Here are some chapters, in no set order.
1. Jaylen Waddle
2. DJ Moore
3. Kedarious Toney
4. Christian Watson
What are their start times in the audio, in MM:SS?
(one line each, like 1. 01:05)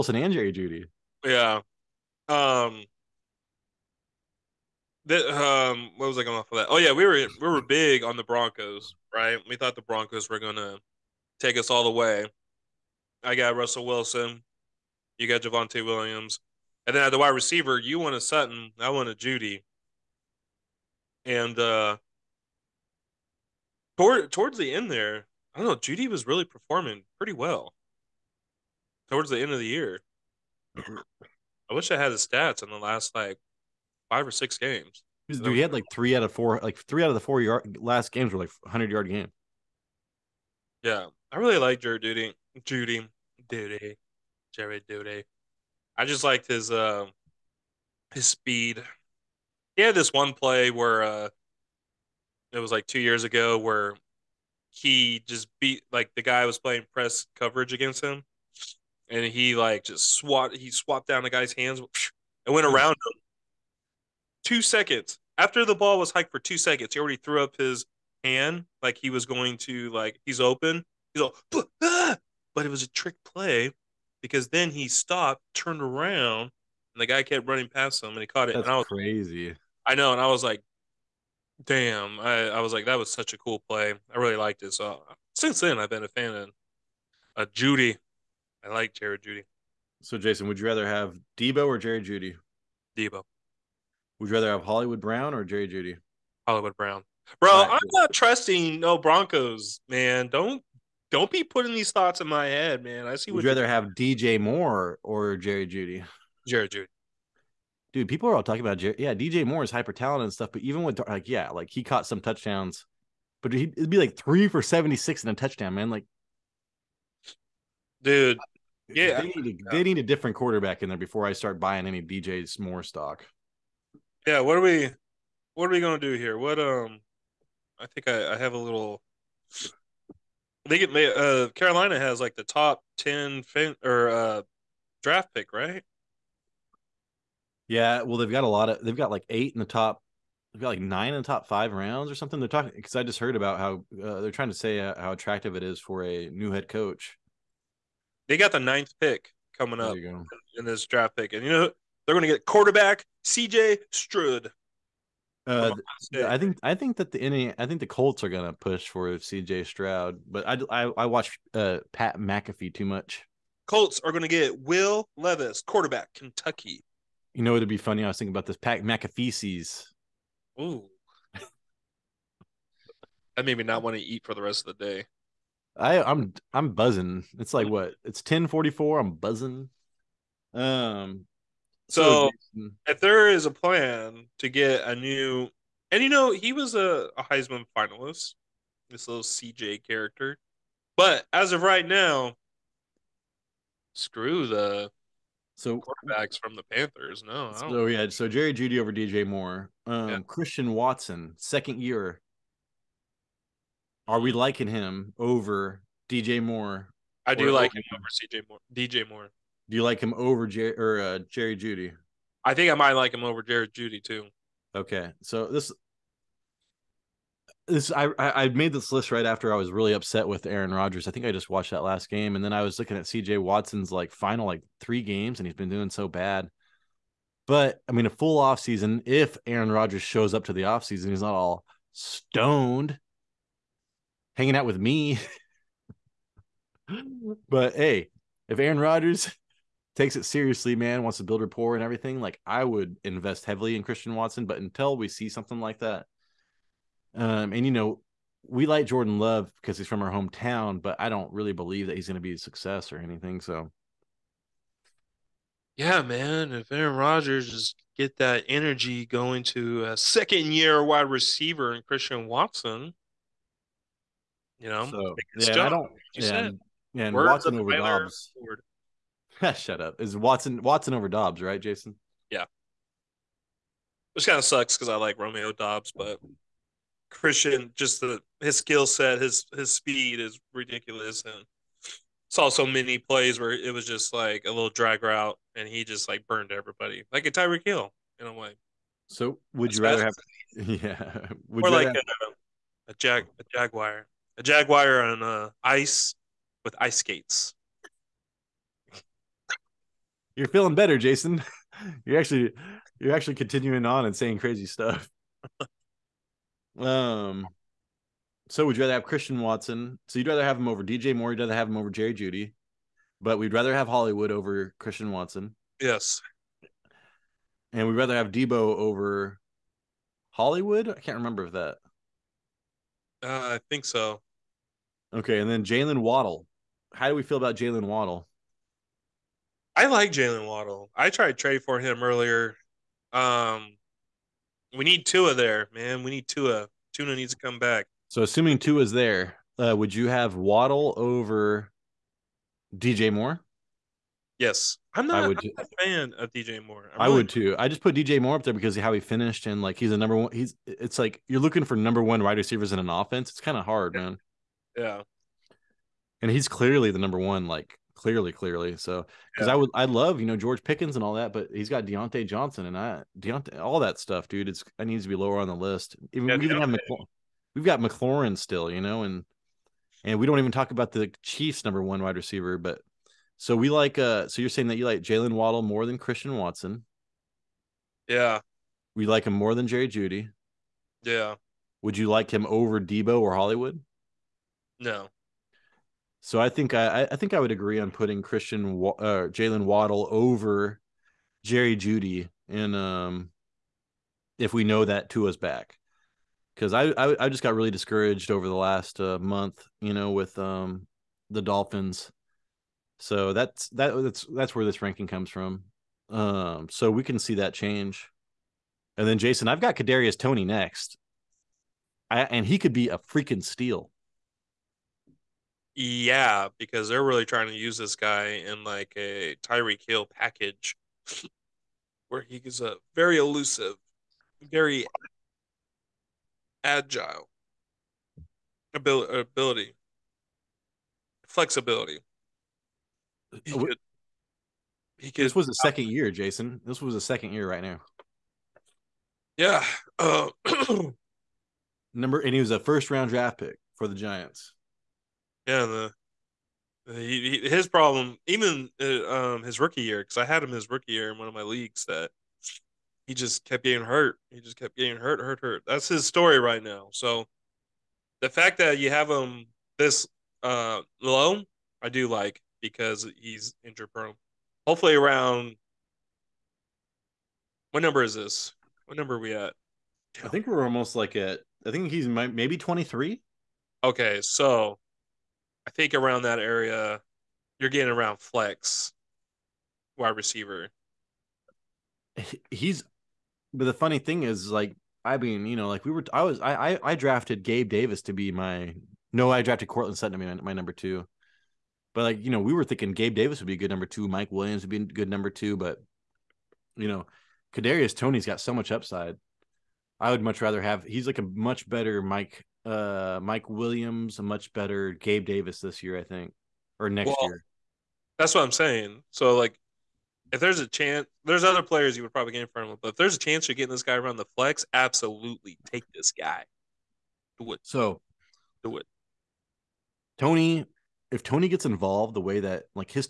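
1. 05:25
2. 01:43
3. 06:49
4. 03:19.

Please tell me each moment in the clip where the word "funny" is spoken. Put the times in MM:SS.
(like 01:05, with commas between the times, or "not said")
02:47, 08:03.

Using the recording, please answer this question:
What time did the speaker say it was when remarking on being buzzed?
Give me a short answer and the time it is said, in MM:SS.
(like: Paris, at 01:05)
10:44, at 02:58.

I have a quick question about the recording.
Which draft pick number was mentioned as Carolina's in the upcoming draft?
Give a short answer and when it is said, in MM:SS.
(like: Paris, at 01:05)
9th, at 02:28.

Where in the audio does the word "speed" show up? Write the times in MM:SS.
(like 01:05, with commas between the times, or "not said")
00:48, 04:39.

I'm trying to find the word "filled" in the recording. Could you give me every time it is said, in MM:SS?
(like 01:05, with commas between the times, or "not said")
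not said.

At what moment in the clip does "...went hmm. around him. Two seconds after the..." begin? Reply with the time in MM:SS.
01:02.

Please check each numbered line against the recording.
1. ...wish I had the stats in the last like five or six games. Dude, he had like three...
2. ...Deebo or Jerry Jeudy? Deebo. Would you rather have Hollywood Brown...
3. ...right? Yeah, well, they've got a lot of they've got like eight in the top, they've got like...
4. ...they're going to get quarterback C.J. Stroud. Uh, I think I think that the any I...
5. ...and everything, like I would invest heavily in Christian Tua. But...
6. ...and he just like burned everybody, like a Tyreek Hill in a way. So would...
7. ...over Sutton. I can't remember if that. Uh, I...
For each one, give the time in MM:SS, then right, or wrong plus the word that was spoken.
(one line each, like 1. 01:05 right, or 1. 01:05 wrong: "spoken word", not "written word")
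1. 00:31 right
2. 01:31 right
3. 02:15 right
4. 02:32 right
5. 04:01 wrong: "Watson", not "Tua"
6. 04:45 right
7. 05:18 wrong: "Hollywood", not "Sutton".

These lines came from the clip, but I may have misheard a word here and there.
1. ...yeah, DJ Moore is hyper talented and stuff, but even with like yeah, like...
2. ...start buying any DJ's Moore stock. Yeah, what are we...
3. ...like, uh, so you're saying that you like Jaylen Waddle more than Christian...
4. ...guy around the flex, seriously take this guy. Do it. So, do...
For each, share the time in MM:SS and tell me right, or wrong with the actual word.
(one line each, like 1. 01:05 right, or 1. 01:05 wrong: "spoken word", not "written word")
1. 01:48 right
2. 02:01 right
3. 06:13 right
4. 08:33 wrong: "absolutely", not "seriously".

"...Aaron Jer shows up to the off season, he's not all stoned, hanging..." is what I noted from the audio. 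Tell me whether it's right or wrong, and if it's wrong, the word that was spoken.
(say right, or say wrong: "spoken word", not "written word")
wrong: "Rodgers", not "Jer".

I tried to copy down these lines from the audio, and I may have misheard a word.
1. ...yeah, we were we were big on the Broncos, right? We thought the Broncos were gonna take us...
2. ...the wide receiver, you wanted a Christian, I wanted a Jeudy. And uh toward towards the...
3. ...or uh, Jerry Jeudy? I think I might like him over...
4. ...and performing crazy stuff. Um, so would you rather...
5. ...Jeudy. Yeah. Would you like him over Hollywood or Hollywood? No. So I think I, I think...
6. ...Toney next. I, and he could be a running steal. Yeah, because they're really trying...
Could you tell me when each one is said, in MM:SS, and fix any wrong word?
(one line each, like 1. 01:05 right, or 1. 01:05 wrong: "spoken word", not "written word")
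1. 00:06 right
2. 00:17 wrong: "Sutton", not "Christian"
3. 03:30 right
4. 05:04 wrong: "saying", not "performing"
5. 06:19 wrong: "Deebo", not "Hollywood"
6. 06:50 wrong: "freaking", not "running".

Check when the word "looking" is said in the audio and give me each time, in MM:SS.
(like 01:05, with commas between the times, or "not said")
03:42, 05:51.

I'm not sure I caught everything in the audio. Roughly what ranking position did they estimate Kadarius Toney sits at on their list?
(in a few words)
23.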